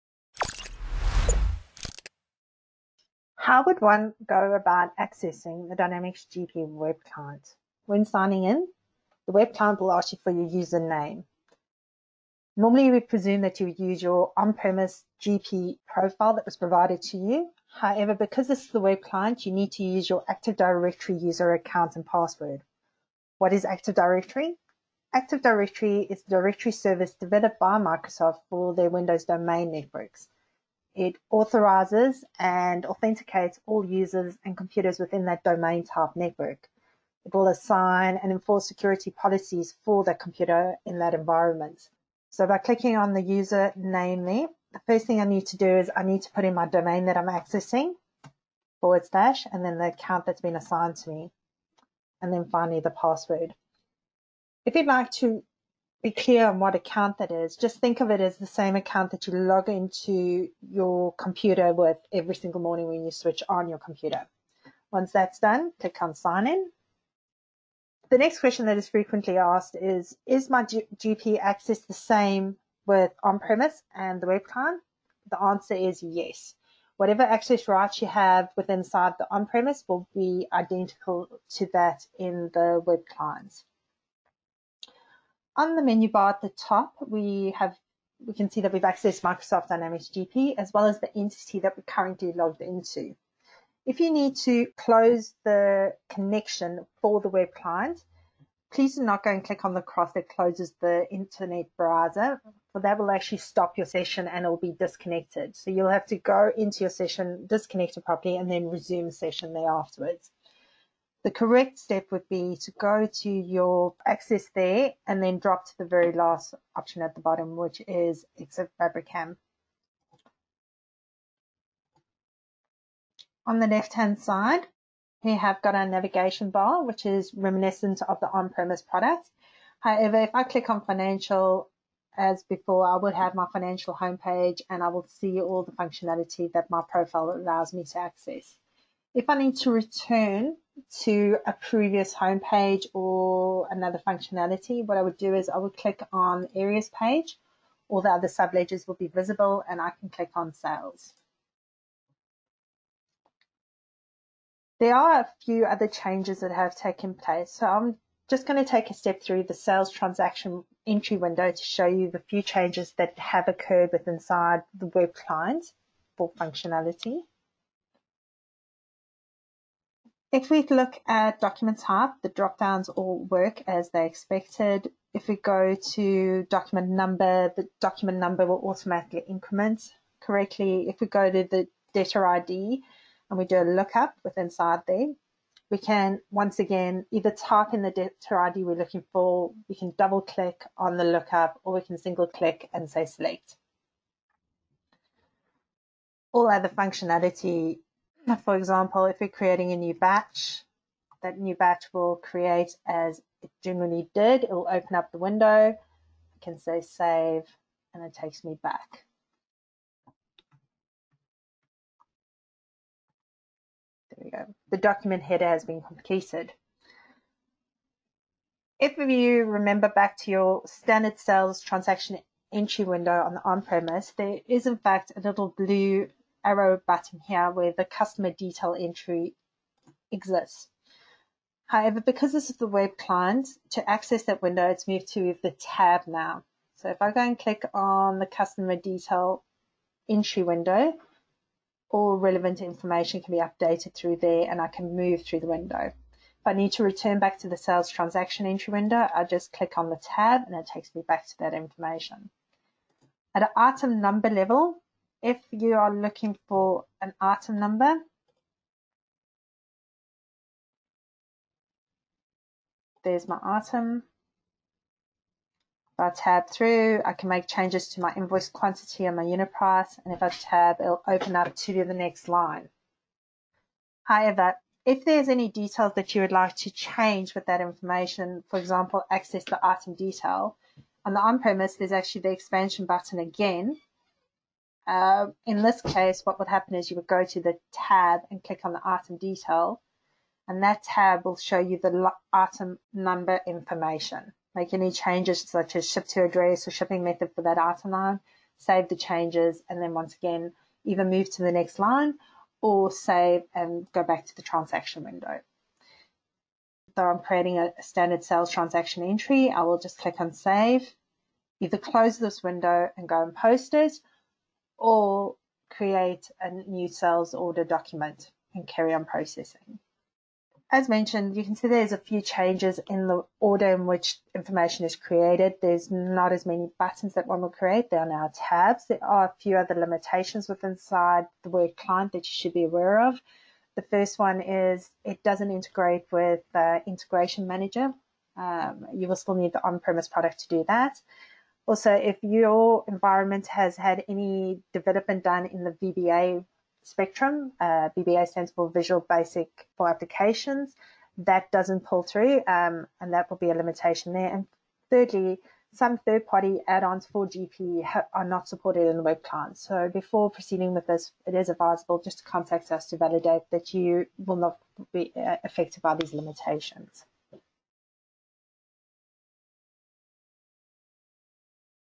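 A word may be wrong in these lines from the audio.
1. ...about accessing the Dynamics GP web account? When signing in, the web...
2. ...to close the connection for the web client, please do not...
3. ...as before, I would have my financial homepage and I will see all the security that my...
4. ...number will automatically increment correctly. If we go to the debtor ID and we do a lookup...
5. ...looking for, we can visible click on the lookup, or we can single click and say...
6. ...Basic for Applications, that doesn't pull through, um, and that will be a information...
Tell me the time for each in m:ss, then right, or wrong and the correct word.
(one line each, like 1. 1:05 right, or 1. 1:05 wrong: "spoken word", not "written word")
1. 0:04 wrong: "client", not "account"
2. 1:34 right
3. 2:12 wrong: "functionality", not "security"
4. 2:58 right
5. 3:08 wrong: "double", not "visible"
6. 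5:49 wrong: "limitation", not "information".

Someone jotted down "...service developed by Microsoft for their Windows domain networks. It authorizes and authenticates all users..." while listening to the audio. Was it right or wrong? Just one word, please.
right.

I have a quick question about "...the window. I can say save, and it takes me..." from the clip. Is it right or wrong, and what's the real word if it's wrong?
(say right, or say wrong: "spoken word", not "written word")
right.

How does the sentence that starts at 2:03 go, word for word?
On the left-hand side, we have got our navigation bar, which is reminiscent of the on-premise product.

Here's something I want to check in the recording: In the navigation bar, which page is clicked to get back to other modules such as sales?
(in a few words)
areas page.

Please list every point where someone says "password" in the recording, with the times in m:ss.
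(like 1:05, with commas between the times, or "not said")
0:22, 0:52.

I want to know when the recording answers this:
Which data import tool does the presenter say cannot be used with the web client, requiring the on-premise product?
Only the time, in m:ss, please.
5:36.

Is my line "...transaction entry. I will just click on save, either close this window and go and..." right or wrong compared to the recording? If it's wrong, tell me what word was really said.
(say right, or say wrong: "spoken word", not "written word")
right.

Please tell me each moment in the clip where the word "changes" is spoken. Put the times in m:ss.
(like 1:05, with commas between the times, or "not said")
2:35, 2:42, 4:27, 4:36, 4:54, 4:58, 5:22.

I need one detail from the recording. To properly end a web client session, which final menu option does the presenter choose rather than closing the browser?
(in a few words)
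exit Fabrikam.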